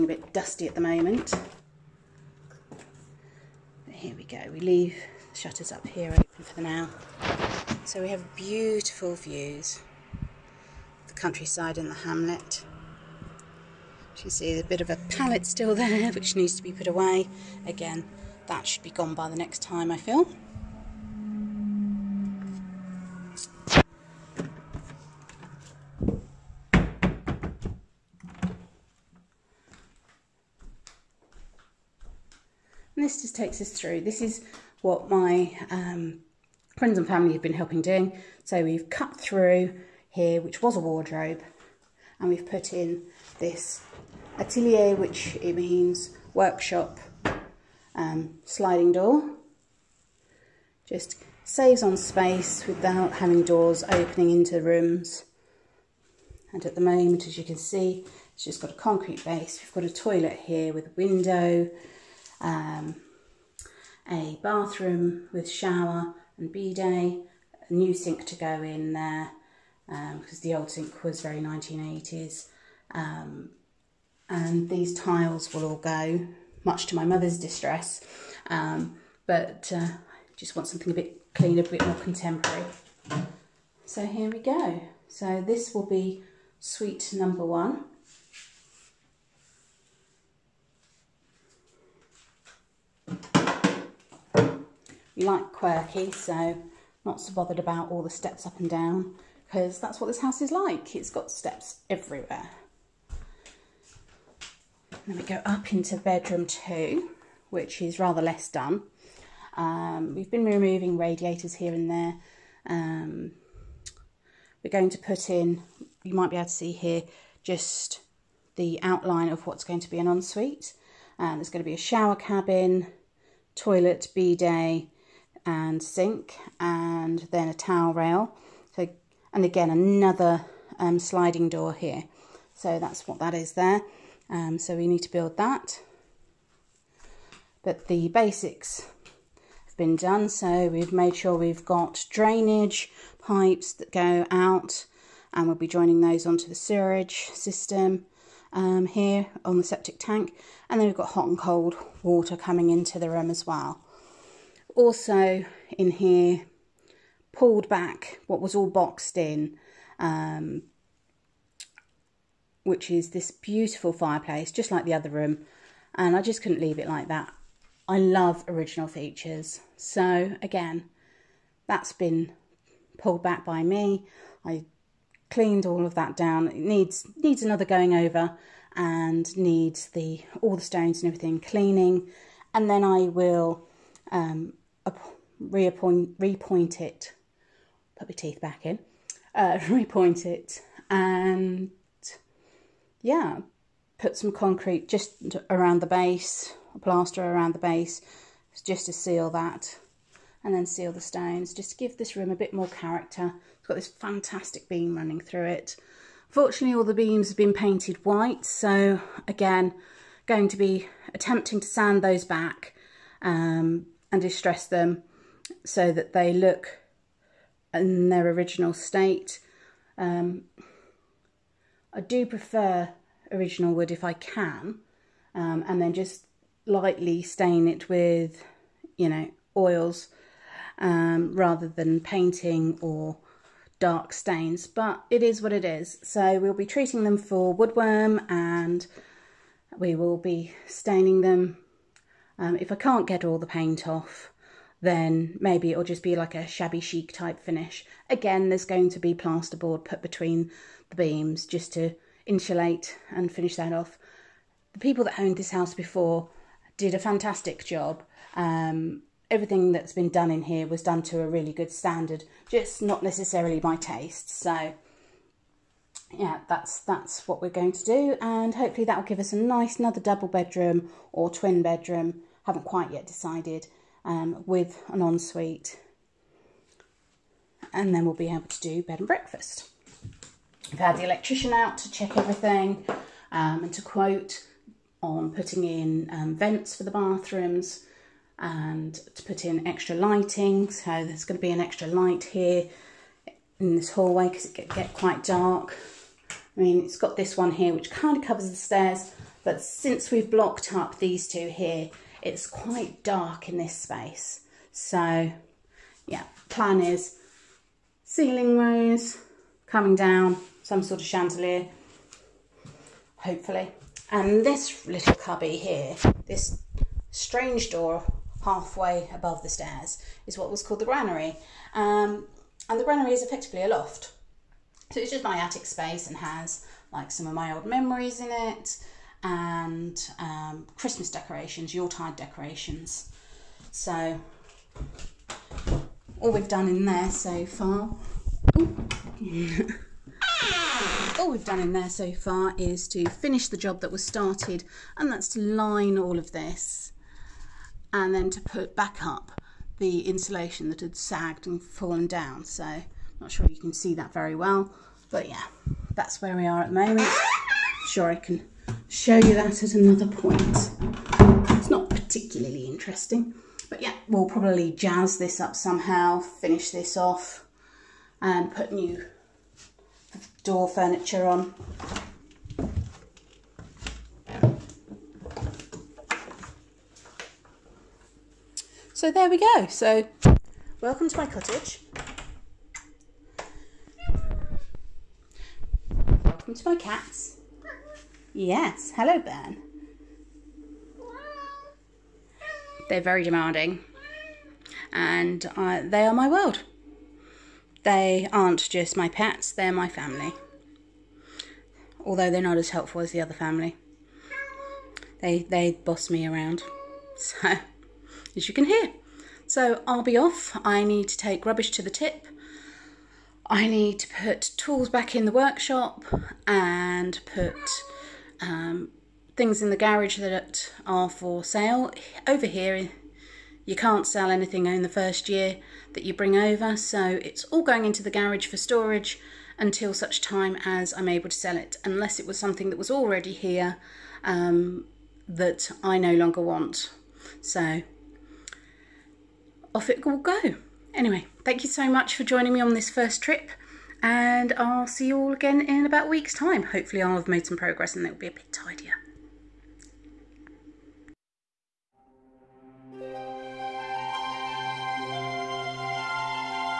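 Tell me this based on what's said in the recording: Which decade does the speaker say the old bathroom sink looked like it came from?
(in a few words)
1980s.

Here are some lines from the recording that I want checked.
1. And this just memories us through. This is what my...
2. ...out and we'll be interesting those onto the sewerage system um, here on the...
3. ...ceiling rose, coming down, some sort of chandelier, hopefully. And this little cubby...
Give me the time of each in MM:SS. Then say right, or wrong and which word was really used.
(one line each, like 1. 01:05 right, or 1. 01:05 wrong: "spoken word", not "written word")
1. 00:32 wrong: "takes", not "memories"
2. 02:24 wrong: "joining", not "interesting"
3. 05:08 right.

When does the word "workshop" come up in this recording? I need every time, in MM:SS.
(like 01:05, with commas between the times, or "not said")
00:46, 06:55.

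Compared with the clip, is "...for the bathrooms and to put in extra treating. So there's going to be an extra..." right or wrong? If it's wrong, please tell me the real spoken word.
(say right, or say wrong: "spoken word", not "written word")
wrong: "lighting", not "treating".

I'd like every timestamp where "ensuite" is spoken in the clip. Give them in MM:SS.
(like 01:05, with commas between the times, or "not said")
02:00, 04:35.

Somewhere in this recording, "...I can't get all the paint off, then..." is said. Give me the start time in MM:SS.
04:02.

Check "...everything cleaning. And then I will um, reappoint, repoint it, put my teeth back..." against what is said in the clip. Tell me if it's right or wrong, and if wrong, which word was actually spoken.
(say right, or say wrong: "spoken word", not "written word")
right.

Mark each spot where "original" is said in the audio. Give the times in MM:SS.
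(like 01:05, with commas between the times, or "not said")
02:48, 03:38, 03:43.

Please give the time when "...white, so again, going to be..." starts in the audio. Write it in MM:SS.
03:28.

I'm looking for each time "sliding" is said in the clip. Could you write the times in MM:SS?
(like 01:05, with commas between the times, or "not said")
00:48, 02:10.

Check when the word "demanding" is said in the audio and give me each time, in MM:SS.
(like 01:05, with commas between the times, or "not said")
06:33.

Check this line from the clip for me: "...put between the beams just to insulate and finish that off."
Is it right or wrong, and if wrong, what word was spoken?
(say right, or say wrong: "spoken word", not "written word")
right.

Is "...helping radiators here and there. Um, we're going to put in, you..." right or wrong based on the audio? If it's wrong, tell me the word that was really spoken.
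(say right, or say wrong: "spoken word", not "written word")
wrong: "removing", not "helping".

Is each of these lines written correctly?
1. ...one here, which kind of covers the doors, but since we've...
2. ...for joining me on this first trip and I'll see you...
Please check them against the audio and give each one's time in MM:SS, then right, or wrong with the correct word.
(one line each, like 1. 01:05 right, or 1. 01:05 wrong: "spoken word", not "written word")
1. 04:57 wrong: "stairs", not "doors"
2. 07:22 right.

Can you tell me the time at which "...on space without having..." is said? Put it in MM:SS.
00:51.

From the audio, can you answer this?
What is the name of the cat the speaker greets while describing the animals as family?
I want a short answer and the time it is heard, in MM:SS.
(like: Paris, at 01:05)
Bern, at 06:29.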